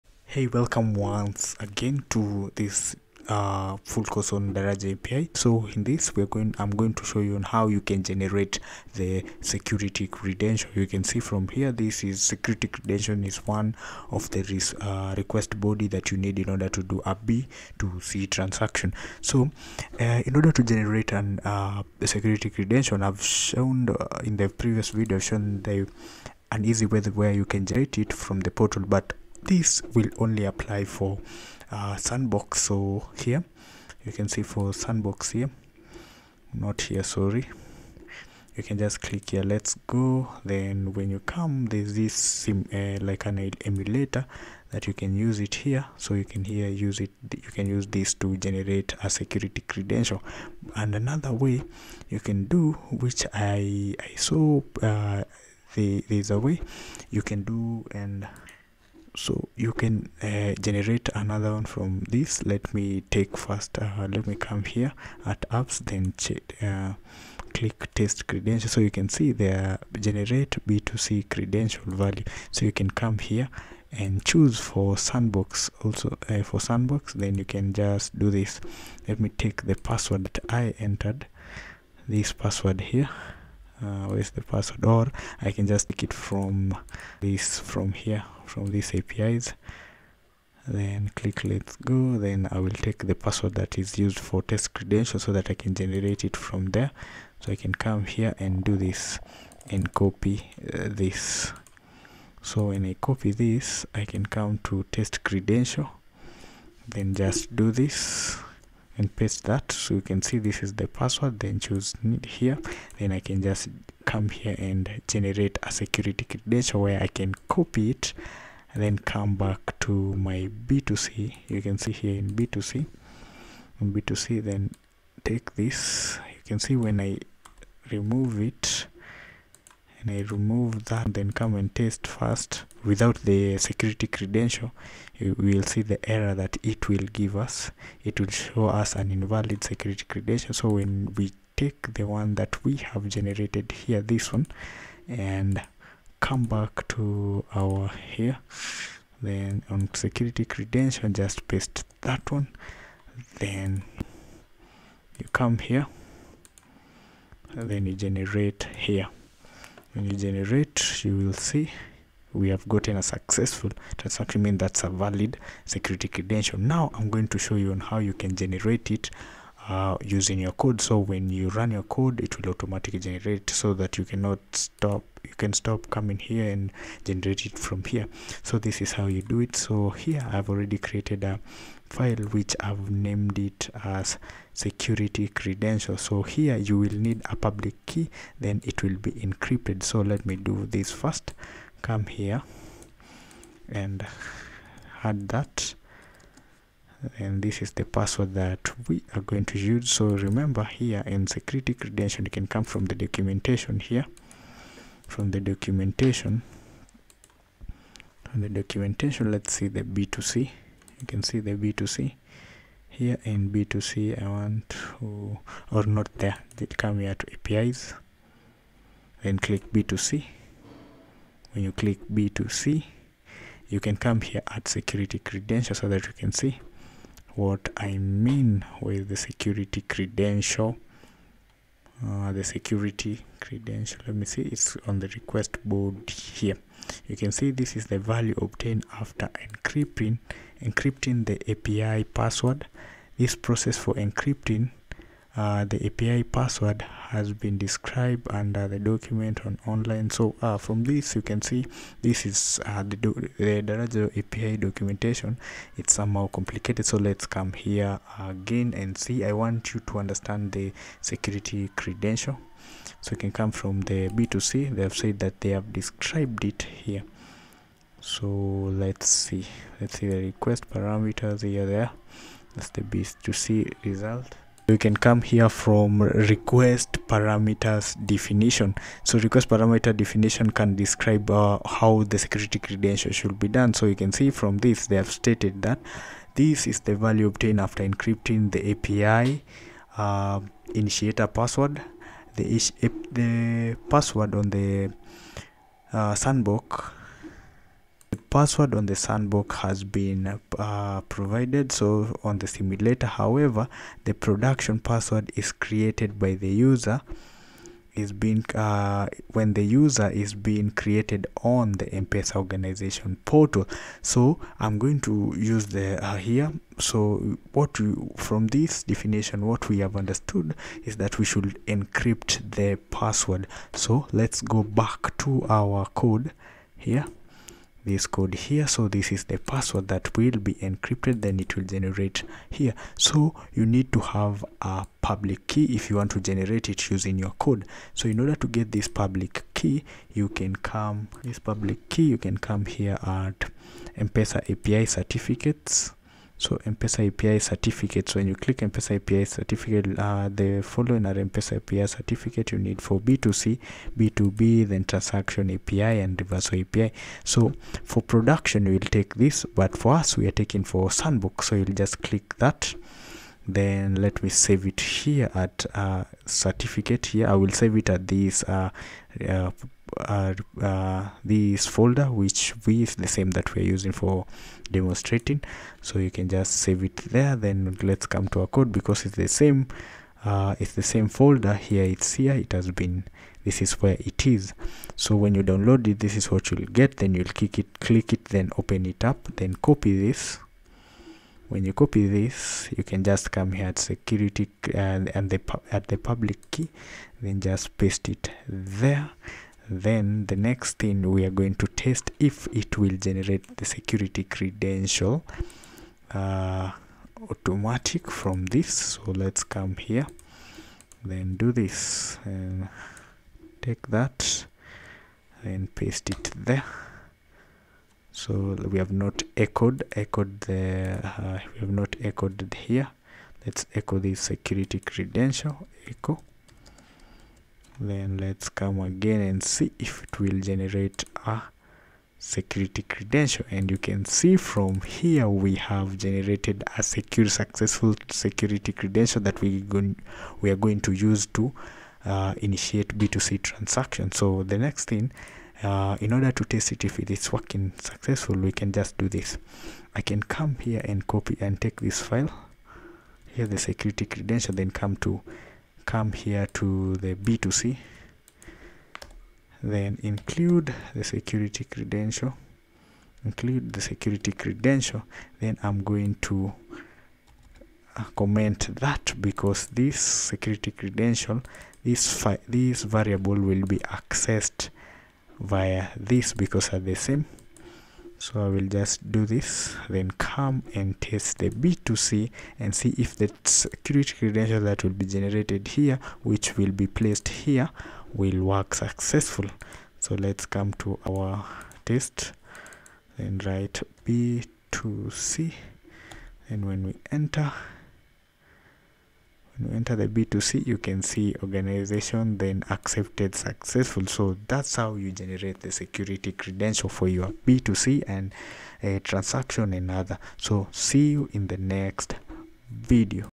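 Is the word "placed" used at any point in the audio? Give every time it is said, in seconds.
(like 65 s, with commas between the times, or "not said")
486 s.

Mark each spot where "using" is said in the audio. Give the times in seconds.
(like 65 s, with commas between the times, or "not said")
170 s, 336 s, 373 s.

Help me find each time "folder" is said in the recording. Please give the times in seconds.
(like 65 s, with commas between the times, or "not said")
371 s, 381 s.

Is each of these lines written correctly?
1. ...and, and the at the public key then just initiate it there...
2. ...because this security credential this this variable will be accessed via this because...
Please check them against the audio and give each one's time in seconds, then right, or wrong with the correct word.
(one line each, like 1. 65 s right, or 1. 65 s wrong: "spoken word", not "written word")
1. 394 s wrong: "paste", not "initiate"
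2. 469 s right.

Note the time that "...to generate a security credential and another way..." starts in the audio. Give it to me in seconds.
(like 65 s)
48 s.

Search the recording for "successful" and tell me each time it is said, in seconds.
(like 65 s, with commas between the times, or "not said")
163 s, 437 s, 447 s, 488 s, 503 s.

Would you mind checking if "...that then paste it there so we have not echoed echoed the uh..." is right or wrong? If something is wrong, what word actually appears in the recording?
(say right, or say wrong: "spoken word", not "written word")
right.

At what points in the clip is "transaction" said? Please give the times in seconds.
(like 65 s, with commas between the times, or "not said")
18 s, 163 s, 354 s, 443 s, 508 s.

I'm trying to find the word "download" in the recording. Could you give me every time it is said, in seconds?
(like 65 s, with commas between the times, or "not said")
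385 s.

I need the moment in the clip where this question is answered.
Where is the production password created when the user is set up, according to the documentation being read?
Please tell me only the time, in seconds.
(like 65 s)
311 s.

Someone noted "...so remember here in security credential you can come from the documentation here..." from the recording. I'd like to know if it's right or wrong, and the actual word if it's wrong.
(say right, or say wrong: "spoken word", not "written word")
right.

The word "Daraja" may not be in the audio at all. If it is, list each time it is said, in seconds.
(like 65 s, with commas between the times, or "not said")
4 s, 253 s.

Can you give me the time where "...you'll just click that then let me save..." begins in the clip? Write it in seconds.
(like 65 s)
361 s.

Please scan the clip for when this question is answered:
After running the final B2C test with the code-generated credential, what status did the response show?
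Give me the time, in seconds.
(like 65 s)
502 s.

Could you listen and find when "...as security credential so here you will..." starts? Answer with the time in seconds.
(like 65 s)
183 s.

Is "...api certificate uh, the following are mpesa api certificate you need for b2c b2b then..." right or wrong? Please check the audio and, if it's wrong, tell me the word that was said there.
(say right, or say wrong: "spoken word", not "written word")
right.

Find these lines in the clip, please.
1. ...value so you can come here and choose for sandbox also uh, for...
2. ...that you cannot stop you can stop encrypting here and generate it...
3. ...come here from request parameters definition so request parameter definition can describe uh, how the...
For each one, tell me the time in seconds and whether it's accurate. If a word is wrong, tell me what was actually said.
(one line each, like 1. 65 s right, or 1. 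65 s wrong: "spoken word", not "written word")
1. 71 s right
2. 173 s wrong: "coming", not "encrypting"
3. 275 s right.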